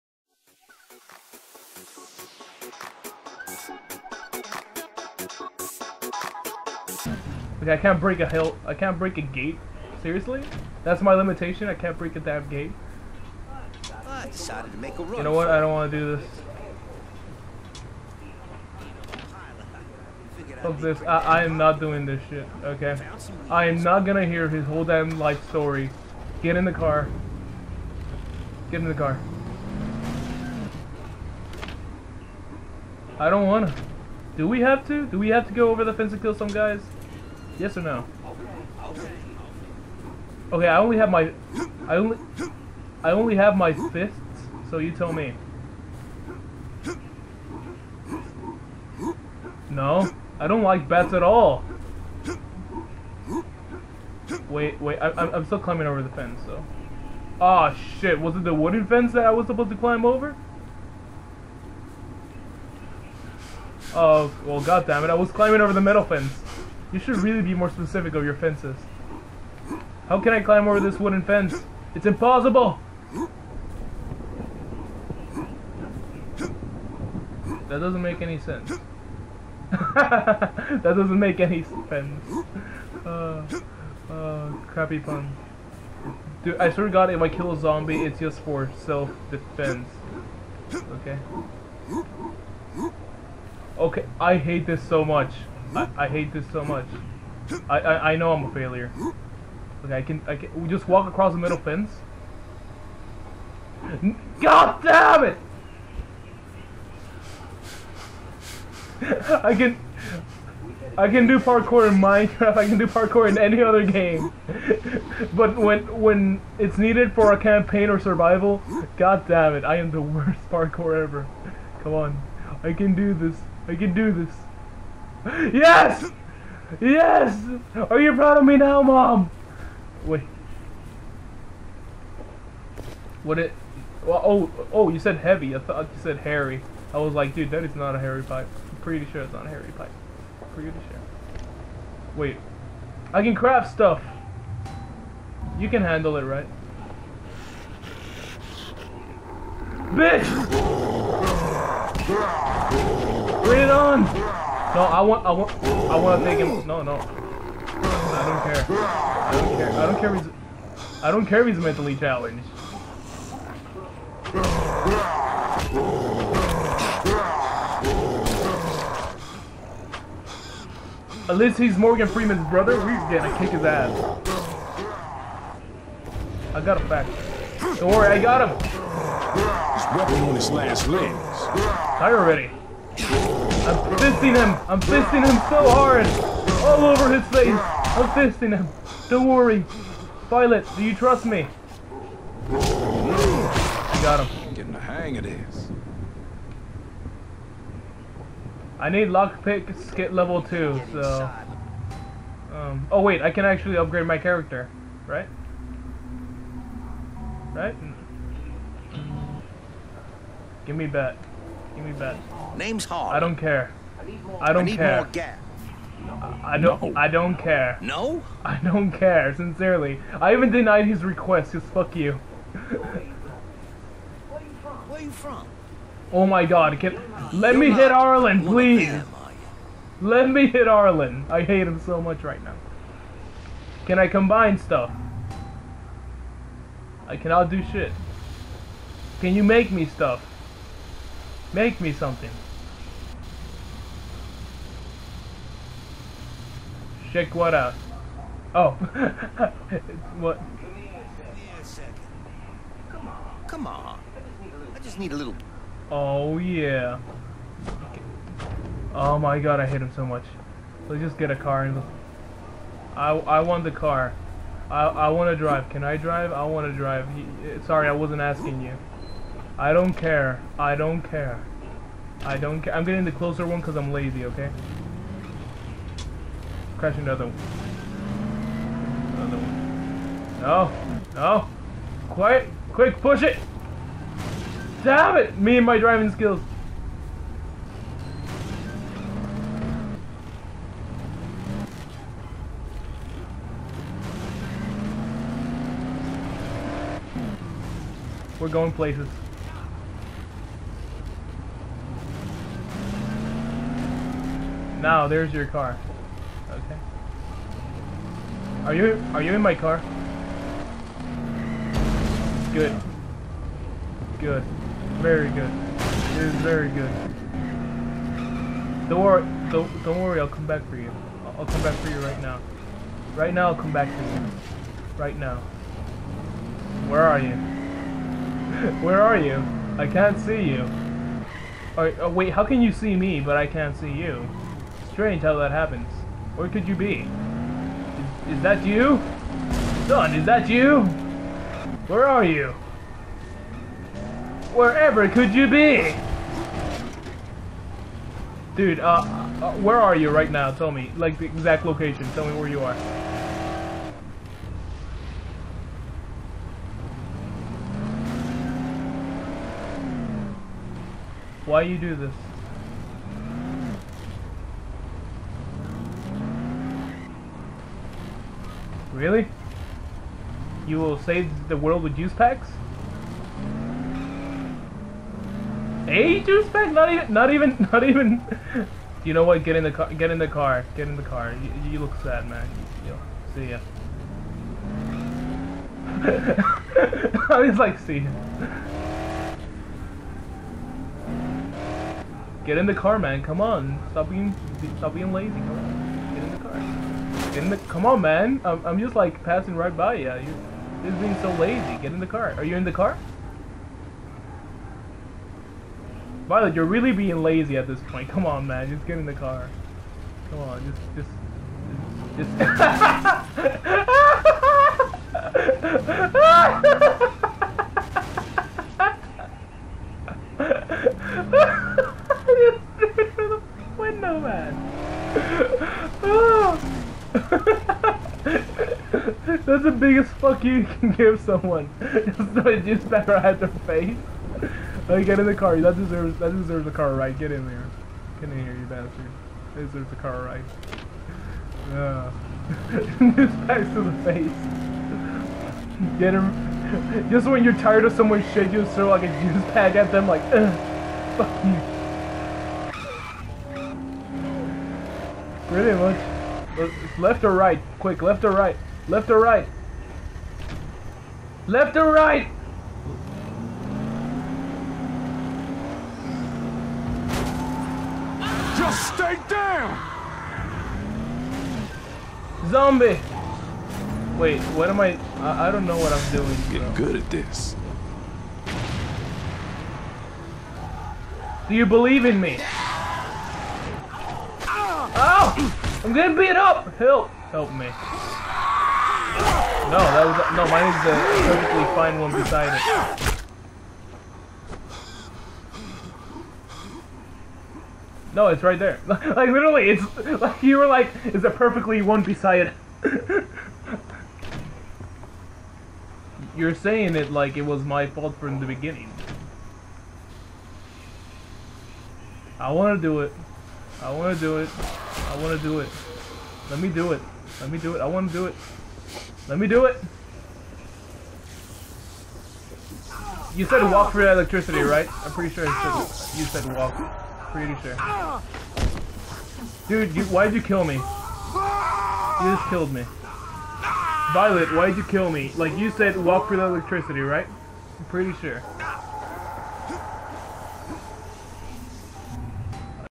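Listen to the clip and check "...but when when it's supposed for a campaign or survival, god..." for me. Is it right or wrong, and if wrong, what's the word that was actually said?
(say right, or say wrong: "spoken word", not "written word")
wrong: "needed", not "supposed".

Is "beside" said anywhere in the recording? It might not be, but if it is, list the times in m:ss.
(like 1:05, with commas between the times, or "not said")
8:12, 8:22.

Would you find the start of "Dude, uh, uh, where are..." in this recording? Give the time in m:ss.
5:48.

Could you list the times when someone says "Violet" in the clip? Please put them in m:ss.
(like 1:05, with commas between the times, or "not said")
3:10, 6:46, 8:54.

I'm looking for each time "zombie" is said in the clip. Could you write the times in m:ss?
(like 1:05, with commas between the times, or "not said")
1:27, 7:52.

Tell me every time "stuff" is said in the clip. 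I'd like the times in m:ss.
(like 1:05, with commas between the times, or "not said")
2:23, 3:54, 3:59.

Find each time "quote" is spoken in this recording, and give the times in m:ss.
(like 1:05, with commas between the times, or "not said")
not said.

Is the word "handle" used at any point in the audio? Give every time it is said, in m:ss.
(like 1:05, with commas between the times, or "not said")
2:25.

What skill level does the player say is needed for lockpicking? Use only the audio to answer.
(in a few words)
level 2.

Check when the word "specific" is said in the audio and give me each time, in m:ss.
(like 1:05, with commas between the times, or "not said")
1:07.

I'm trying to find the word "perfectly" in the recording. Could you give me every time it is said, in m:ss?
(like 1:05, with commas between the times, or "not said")
8:11, 8:21.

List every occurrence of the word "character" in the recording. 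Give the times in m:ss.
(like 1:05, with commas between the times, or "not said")
3:24.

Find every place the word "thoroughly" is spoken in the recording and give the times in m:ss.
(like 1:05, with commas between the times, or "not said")
not said.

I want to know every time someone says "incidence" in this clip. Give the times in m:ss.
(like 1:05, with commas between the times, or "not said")
not said.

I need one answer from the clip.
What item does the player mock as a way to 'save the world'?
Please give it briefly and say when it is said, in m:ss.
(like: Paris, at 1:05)
juice packs, at 6:11.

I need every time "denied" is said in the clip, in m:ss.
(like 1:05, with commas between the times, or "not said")
3:40.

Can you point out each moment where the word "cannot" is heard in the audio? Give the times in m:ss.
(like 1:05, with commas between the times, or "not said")
3:57.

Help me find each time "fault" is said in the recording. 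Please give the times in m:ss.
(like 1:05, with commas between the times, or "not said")
8:27.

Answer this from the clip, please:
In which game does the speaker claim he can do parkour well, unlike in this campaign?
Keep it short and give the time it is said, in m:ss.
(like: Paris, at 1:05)
Minecraft, at 1:51.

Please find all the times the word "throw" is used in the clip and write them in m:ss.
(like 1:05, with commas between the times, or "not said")
7:12, 7:28.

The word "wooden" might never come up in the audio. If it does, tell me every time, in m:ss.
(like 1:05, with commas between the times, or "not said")
0:58, 1:10.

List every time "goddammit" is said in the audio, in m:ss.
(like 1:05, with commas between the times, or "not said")
1:04.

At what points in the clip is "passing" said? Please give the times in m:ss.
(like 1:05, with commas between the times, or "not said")
6:39.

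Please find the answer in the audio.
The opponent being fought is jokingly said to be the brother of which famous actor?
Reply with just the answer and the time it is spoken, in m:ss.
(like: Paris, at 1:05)
Morgan Freeman, at 2:51.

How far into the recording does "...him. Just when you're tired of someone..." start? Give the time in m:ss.
7:26.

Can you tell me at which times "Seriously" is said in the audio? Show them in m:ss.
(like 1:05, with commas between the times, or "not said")
0:10.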